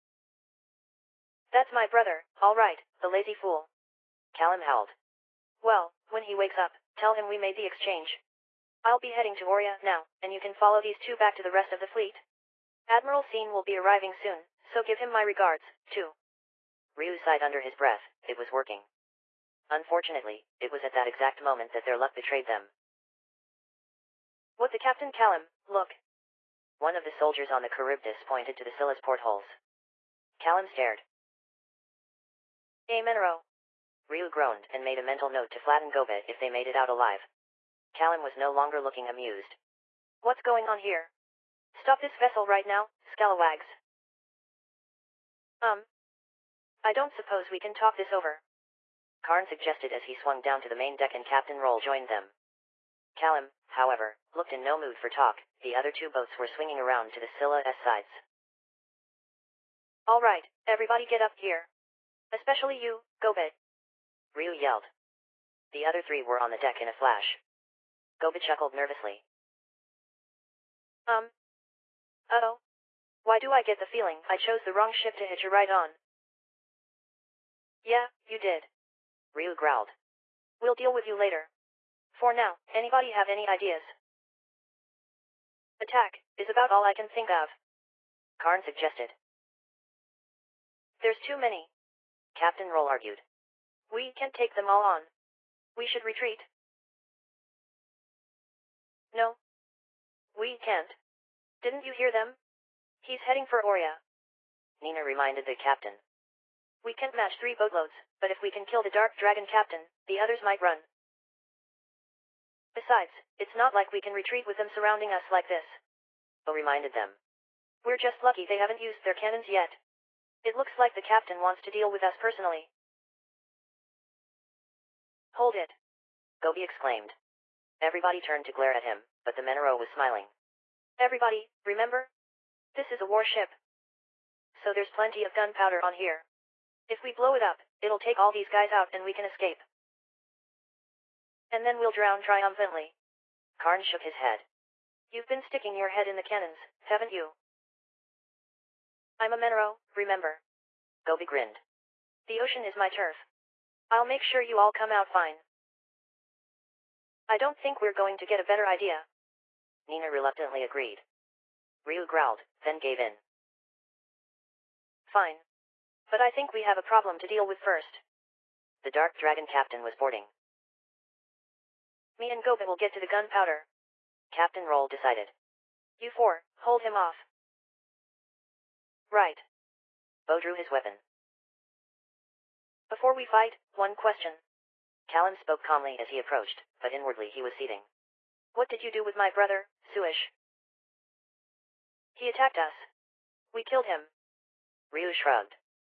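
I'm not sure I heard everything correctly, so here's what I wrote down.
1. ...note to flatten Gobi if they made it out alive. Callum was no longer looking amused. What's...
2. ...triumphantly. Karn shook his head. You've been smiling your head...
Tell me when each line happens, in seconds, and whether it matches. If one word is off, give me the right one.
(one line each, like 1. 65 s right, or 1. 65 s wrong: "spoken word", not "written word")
1. 35 s right
2. 142 s wrong: "sticking", not "smiling".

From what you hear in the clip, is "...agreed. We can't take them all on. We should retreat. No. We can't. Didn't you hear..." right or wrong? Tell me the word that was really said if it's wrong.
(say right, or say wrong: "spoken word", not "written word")
wrong: "argued", not "agreed".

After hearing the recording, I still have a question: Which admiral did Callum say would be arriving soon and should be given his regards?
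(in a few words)
Admiral Scene.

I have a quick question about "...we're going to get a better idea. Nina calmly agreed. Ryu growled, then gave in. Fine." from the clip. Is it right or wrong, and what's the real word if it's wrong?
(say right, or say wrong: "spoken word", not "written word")
wrong: "reluctantly", not "calmly".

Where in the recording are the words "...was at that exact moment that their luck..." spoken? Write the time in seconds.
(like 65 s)
20 s.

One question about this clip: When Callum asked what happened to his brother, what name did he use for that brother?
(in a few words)
Suish.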